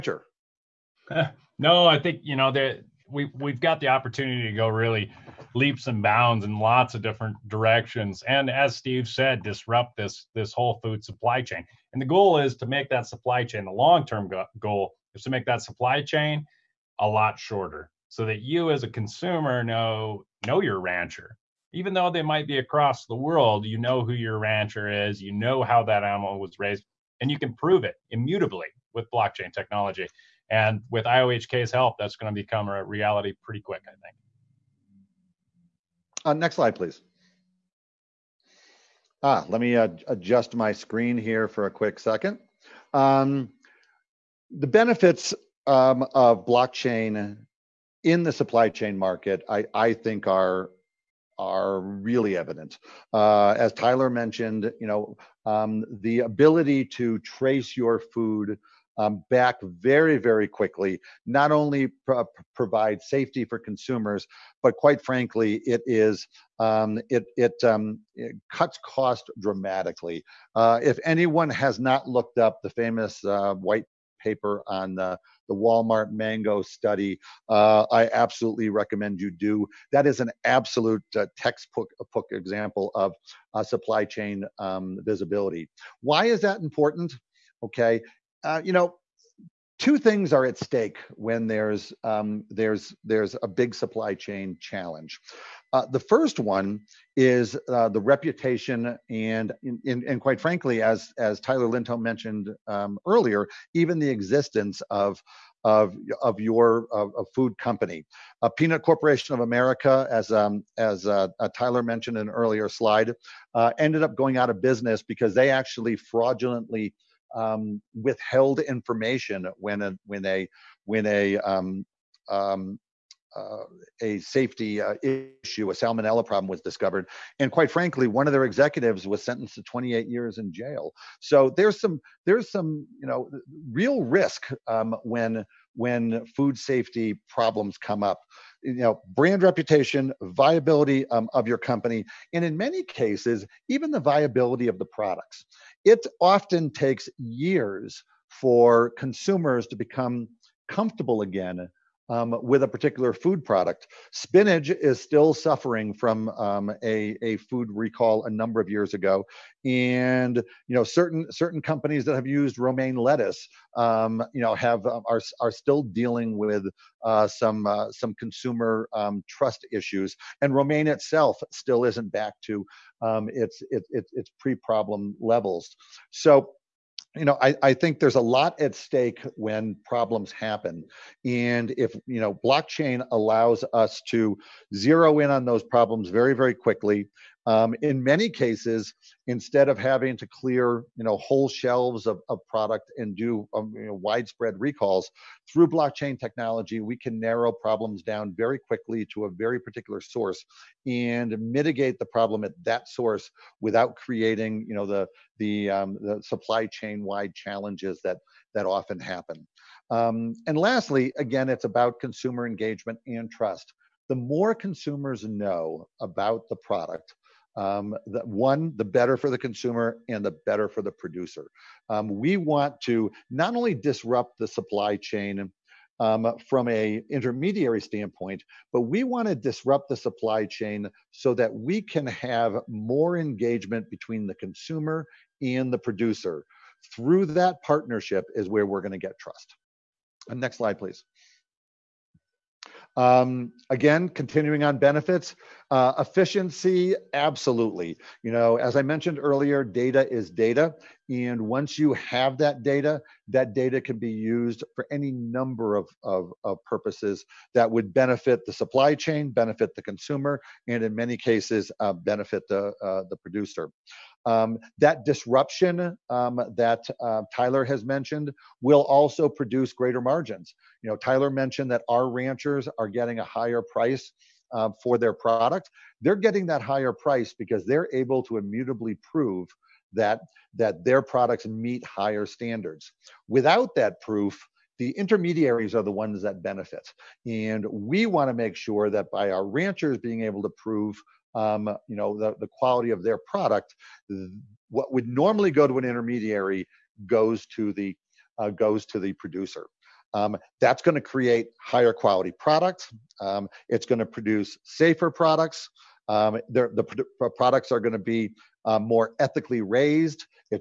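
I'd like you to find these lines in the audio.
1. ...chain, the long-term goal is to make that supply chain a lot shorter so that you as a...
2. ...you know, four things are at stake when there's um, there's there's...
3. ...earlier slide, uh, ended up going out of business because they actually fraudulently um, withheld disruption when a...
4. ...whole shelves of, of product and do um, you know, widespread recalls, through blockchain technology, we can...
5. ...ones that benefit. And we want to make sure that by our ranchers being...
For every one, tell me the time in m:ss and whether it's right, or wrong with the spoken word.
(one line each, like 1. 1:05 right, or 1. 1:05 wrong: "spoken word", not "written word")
1. 0:13 right
2. 1:28 wrong: "two", not "four"
3. 1:52 wrong: "information", not "disruption"
4. 3:11 right
5. 4:45 right.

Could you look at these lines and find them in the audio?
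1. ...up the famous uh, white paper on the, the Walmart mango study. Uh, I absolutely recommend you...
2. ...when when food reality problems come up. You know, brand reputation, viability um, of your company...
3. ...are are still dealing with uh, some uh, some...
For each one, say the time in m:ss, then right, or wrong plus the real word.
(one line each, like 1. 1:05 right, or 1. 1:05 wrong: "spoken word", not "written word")
1. 1:12 right
2. 2:15 wrong: "safety", not "reality"
3. 2:45 right.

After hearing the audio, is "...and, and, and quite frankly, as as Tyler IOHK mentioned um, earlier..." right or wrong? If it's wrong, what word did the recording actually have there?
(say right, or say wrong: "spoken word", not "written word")
wrong: "Linton", not "IOHK".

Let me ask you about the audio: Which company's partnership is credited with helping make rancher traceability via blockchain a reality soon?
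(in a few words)
IOHK.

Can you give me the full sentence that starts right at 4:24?
Um, that disruption um, that uh, Tyler has mentioned will also produce greater margins.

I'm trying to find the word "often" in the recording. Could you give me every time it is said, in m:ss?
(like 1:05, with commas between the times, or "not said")
2:26, 3:28.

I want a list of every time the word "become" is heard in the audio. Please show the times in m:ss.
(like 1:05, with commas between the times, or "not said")
0:32, 2:29.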